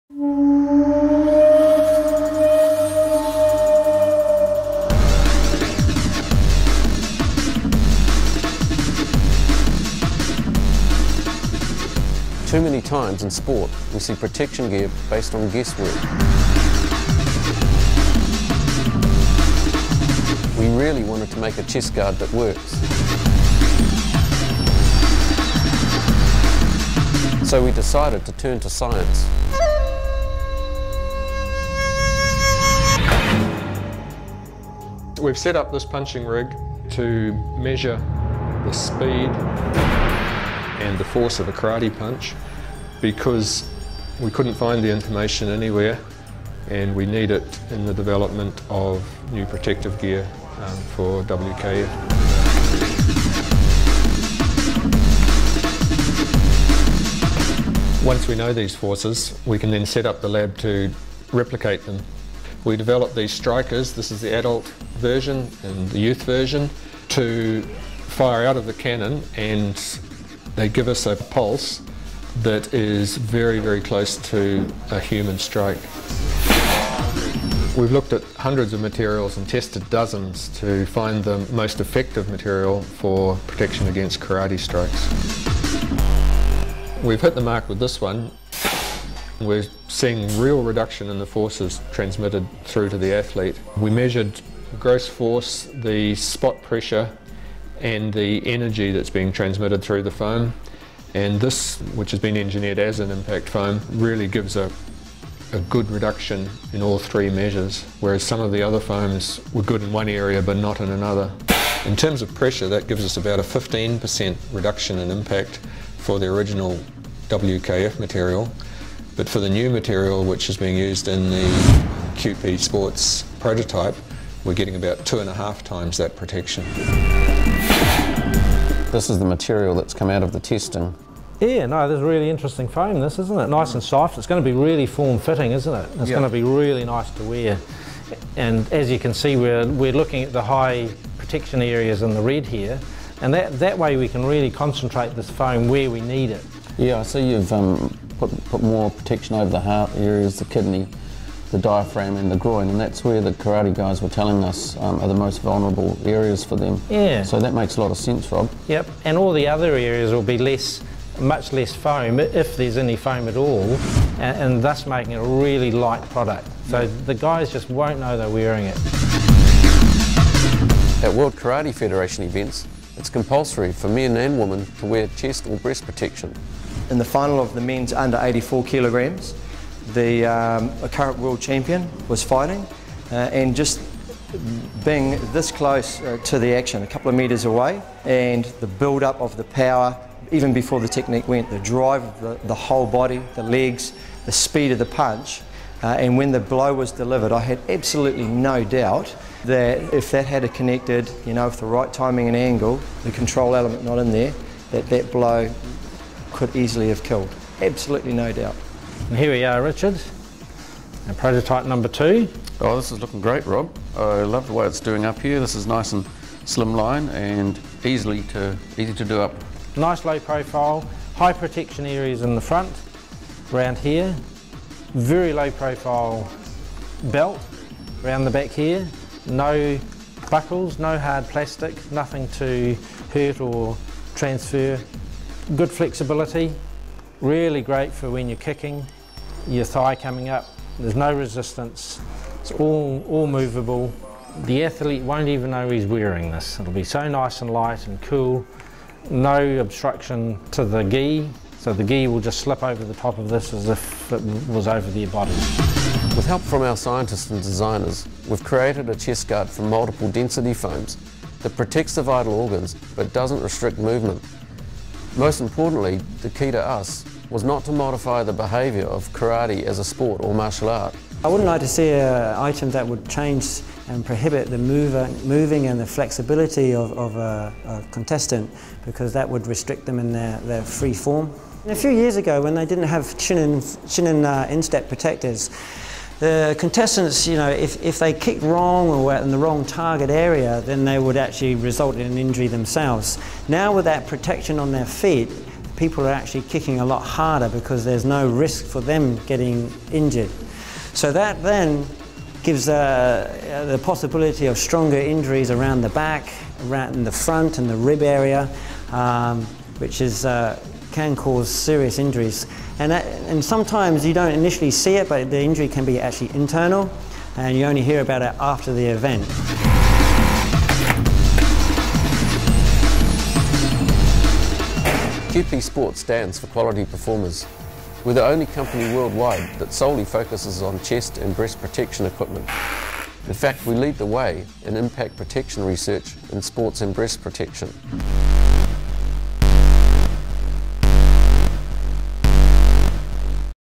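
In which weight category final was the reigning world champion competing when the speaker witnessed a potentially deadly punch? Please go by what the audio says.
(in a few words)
men's under 84 kilograms.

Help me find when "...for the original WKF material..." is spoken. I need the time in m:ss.
1:55.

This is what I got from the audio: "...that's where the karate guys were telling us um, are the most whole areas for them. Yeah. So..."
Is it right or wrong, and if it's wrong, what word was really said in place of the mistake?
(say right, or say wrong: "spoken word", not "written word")
wrong: "vulnerable", not "whole".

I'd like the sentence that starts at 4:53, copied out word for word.
Now with that protection on their feet, people are actually kicking a lot harder because there's no risk for them getting injured.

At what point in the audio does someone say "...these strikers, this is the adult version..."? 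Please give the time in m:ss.
1:03.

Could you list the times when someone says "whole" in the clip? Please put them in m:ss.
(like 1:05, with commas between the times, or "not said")
3:12.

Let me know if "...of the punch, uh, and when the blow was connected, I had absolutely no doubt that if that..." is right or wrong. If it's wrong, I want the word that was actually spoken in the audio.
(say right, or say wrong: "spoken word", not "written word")
wrong: "delivered", not "connected".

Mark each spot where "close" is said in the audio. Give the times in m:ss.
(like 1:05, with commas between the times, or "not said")
1:13, 3:05.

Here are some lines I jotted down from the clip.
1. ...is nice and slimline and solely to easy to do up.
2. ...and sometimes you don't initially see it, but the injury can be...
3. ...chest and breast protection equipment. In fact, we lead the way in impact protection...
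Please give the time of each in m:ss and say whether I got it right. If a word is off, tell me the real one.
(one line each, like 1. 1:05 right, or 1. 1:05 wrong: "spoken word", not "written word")
1. 3:35 wrong: "easily", not "solely"
2. 5:13 right
3. 5:30 right.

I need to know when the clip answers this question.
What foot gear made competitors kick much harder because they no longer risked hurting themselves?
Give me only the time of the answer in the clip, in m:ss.
4:44.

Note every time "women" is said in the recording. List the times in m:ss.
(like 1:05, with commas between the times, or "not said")
2:54.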